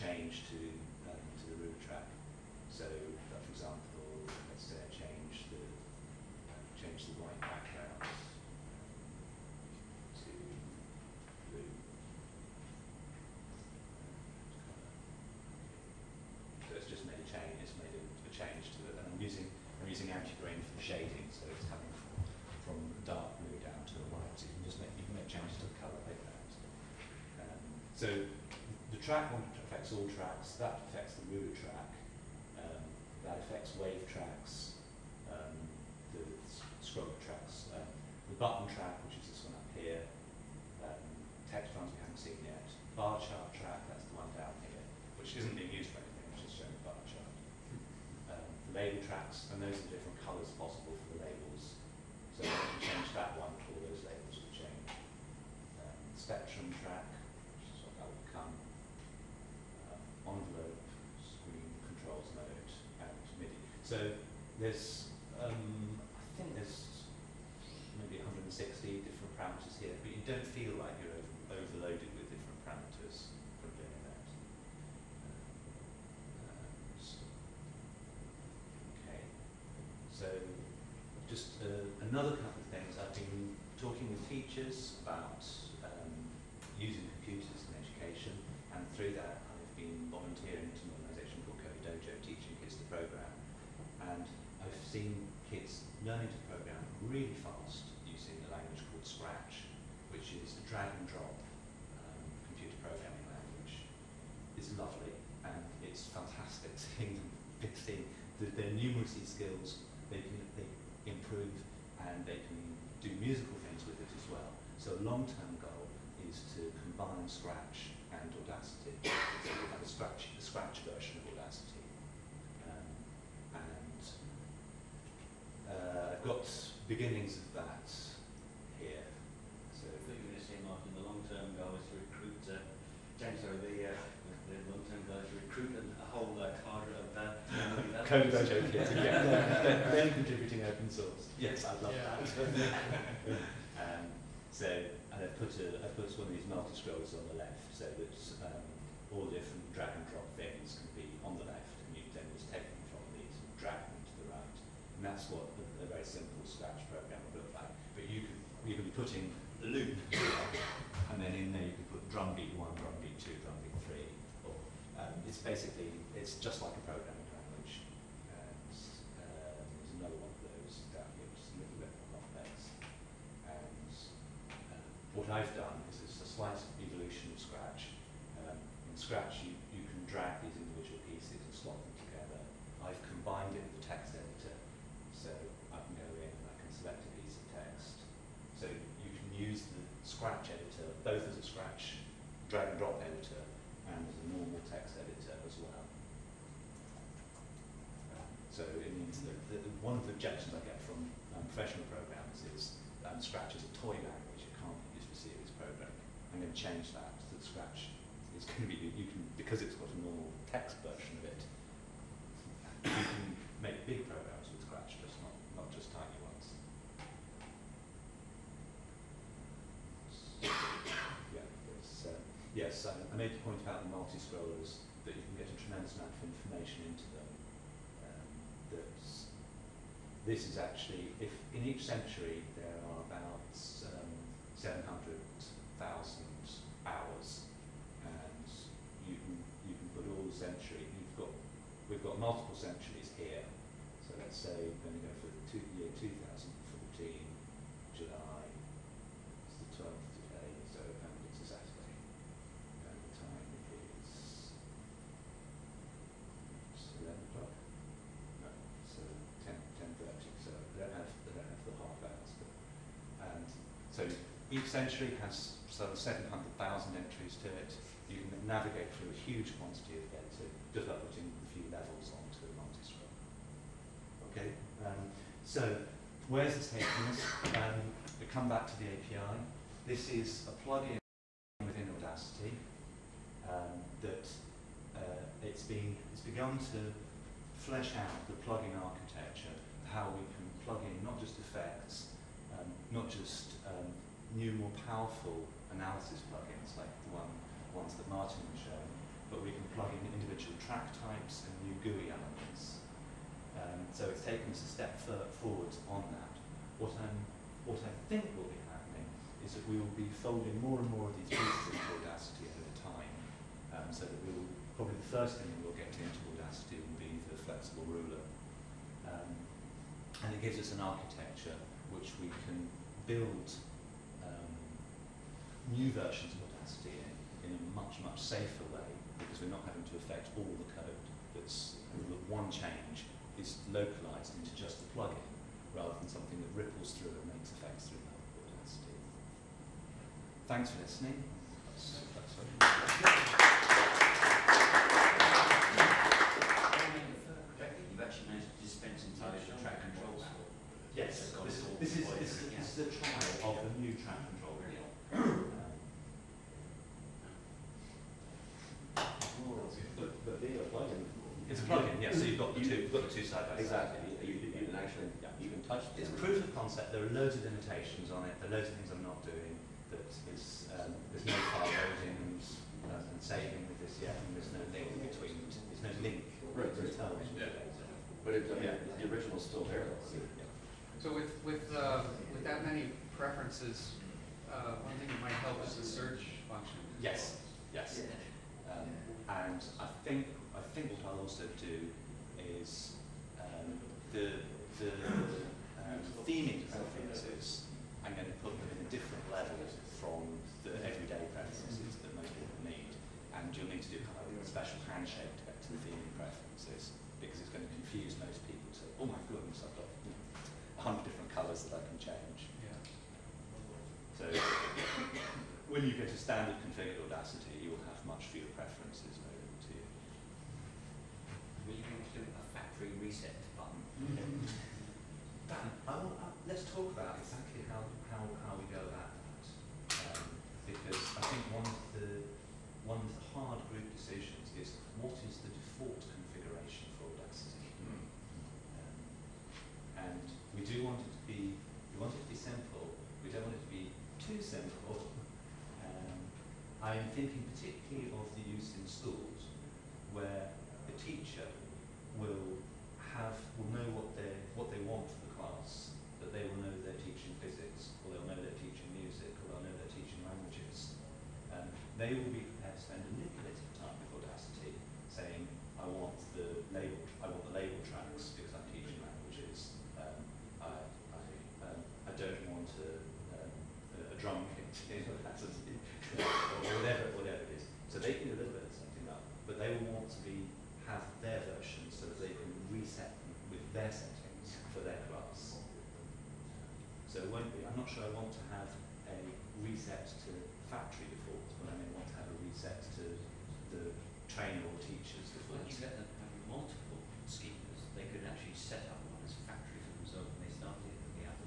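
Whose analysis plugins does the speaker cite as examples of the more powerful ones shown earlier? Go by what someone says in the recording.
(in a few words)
Martin.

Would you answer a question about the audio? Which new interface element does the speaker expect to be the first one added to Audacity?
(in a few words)
the flexible ruler.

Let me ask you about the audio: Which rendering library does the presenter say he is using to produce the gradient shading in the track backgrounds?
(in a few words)
anti-grain.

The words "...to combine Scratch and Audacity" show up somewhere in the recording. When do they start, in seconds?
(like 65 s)
116 s.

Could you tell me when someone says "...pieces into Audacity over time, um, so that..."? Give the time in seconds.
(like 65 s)
311 s.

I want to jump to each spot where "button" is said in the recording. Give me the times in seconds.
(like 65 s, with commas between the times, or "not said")
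38 s, 423 s.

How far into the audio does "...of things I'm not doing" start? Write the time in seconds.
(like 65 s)
368 s.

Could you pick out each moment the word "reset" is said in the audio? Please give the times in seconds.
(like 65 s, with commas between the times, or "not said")
422 s.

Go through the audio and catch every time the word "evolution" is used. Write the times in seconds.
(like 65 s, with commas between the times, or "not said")
176 s.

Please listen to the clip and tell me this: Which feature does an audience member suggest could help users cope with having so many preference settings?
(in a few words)
search function.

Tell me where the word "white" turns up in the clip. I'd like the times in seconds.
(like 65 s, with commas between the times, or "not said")
7 s, 24 s.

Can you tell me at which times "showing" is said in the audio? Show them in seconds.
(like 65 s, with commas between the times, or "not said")
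46 s, 298 s.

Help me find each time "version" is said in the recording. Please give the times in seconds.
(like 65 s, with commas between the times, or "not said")
120 s, 210 s, 325 s.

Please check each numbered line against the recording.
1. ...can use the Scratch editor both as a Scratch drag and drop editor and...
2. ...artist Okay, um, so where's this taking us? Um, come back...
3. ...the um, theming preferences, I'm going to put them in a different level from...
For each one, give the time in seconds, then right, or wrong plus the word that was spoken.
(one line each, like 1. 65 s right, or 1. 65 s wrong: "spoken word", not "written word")
1. 189 s right
2. 272 s right
3. 394 s right.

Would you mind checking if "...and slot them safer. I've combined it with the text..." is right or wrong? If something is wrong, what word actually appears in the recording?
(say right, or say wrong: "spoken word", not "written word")
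wrong: "together", not "safer".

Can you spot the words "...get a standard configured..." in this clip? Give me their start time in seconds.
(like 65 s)
415 s.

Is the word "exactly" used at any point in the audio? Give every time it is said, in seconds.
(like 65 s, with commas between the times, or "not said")
363 s, 427 s.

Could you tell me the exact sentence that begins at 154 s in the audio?
And that's what a, a very simple Scratch program would look like.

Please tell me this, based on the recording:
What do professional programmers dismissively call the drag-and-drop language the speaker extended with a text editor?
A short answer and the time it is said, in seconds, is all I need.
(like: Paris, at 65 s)
toy language, at 203 s.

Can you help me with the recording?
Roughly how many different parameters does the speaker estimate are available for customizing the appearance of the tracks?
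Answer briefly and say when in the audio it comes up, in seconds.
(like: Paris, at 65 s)
160, at 68 s.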